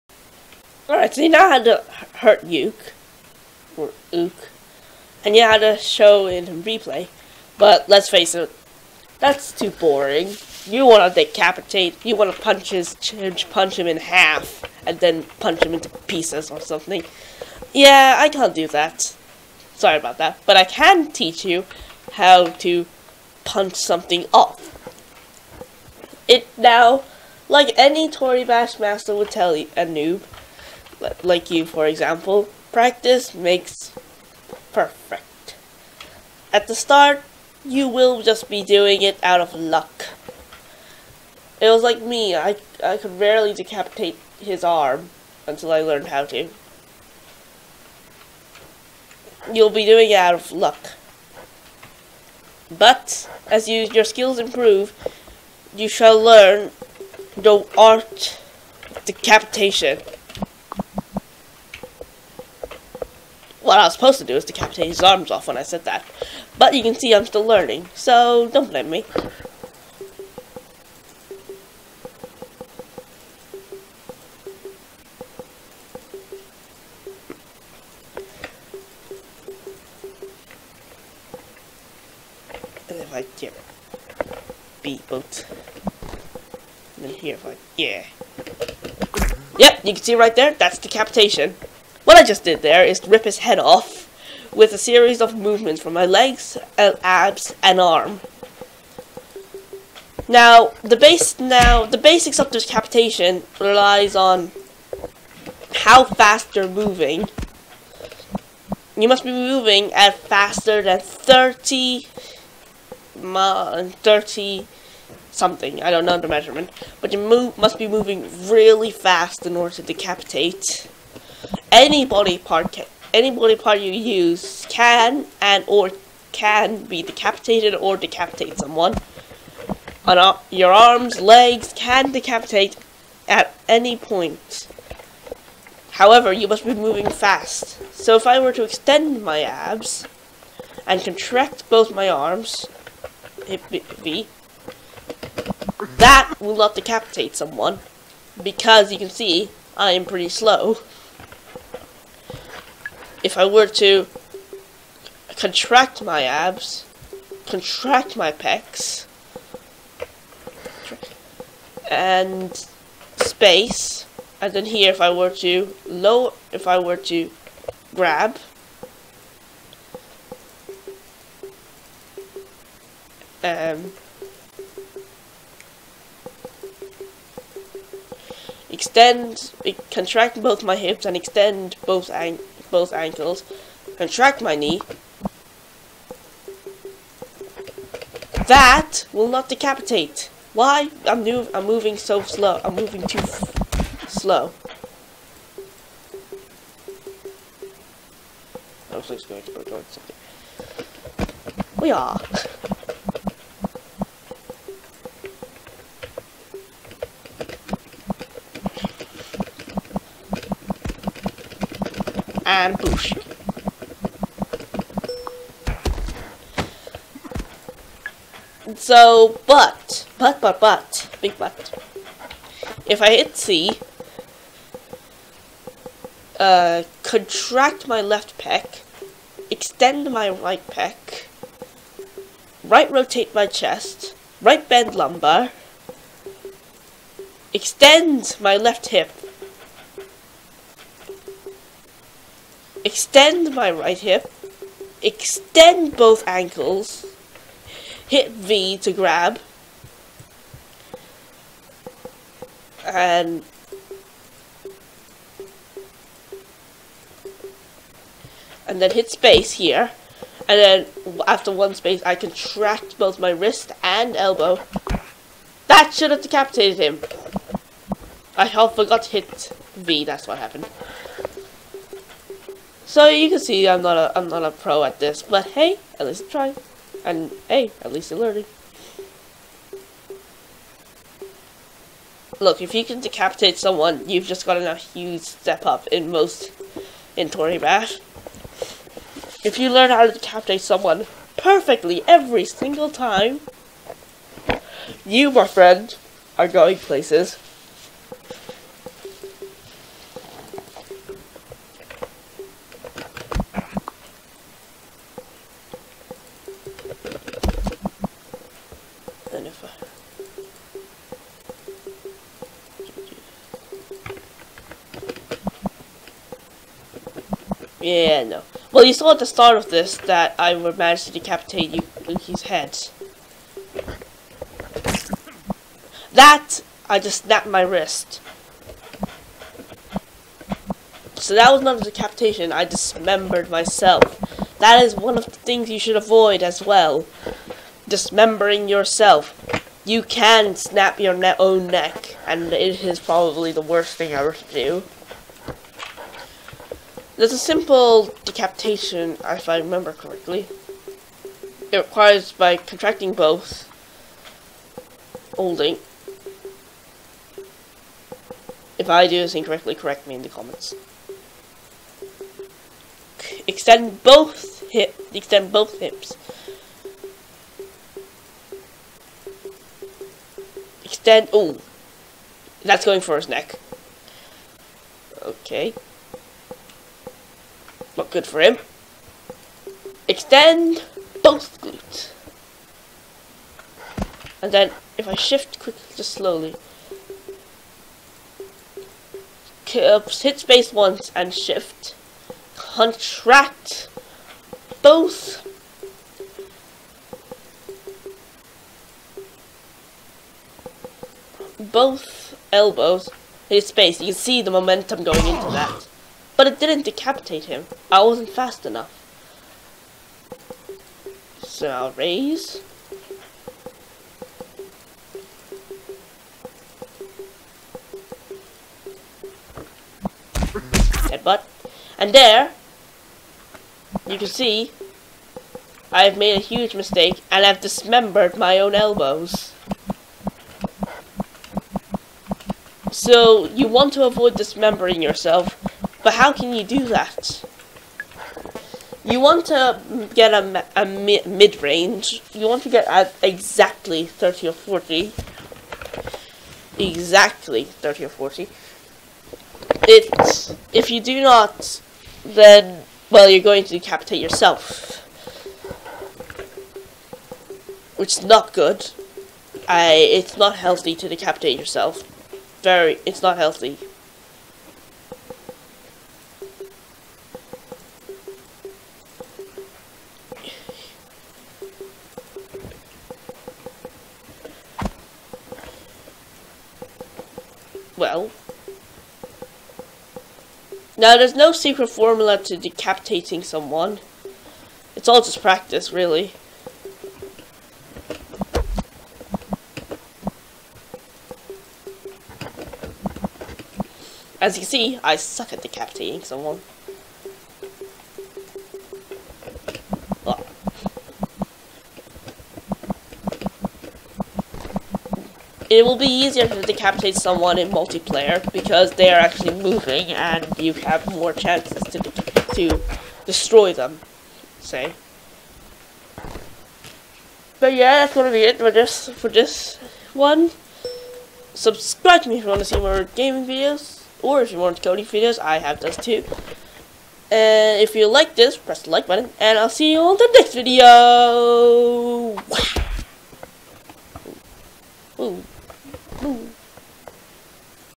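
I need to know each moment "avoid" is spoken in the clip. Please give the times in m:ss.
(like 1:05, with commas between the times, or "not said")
5:35, 7:14.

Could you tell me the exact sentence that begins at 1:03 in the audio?
What I was supposed to do is decapitate his arms off when I said that.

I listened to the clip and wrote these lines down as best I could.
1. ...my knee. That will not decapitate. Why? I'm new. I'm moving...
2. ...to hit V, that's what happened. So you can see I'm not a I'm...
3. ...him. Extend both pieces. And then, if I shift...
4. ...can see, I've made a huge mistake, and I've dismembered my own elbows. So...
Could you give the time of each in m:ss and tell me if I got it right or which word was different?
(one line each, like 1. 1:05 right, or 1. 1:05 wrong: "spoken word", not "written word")
1. 3:04 right
2. 4:29 right
3. 6:18 wrong: "glutes", not "pieces"
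4. 7:04 right.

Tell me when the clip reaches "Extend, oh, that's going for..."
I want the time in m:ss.
6:10.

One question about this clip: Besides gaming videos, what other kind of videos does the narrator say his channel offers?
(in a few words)
coding videos.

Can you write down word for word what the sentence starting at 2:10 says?
On uh, your arms, legs can decapitate at any point.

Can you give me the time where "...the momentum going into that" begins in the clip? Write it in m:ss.
6:44.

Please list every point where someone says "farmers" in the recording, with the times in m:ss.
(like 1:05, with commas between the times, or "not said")
not said.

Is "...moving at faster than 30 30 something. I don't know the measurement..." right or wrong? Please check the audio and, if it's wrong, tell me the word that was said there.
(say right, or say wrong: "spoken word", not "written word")
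right.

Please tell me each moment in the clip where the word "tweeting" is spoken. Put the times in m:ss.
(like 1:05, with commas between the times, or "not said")
not said.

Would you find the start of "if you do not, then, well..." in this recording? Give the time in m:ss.
7:30.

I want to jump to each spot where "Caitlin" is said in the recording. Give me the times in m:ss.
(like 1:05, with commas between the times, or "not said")
not said.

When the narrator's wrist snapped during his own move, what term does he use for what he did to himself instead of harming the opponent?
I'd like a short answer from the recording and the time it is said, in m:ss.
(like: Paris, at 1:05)
dismembered myself, at 5:32.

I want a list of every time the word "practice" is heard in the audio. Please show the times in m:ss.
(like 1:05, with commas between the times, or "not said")
0:32, 8:05.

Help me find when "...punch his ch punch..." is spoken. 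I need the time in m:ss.
0:12.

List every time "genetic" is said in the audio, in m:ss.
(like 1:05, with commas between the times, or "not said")
not said.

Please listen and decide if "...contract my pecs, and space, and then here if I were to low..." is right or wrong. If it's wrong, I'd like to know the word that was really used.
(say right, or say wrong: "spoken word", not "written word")
right.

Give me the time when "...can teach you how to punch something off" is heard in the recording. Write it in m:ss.
0:20.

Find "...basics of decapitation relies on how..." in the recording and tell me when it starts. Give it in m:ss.
1:41.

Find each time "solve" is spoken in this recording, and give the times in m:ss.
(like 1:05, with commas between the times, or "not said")
not said.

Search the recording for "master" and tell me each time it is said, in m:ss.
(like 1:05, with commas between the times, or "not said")
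0:28.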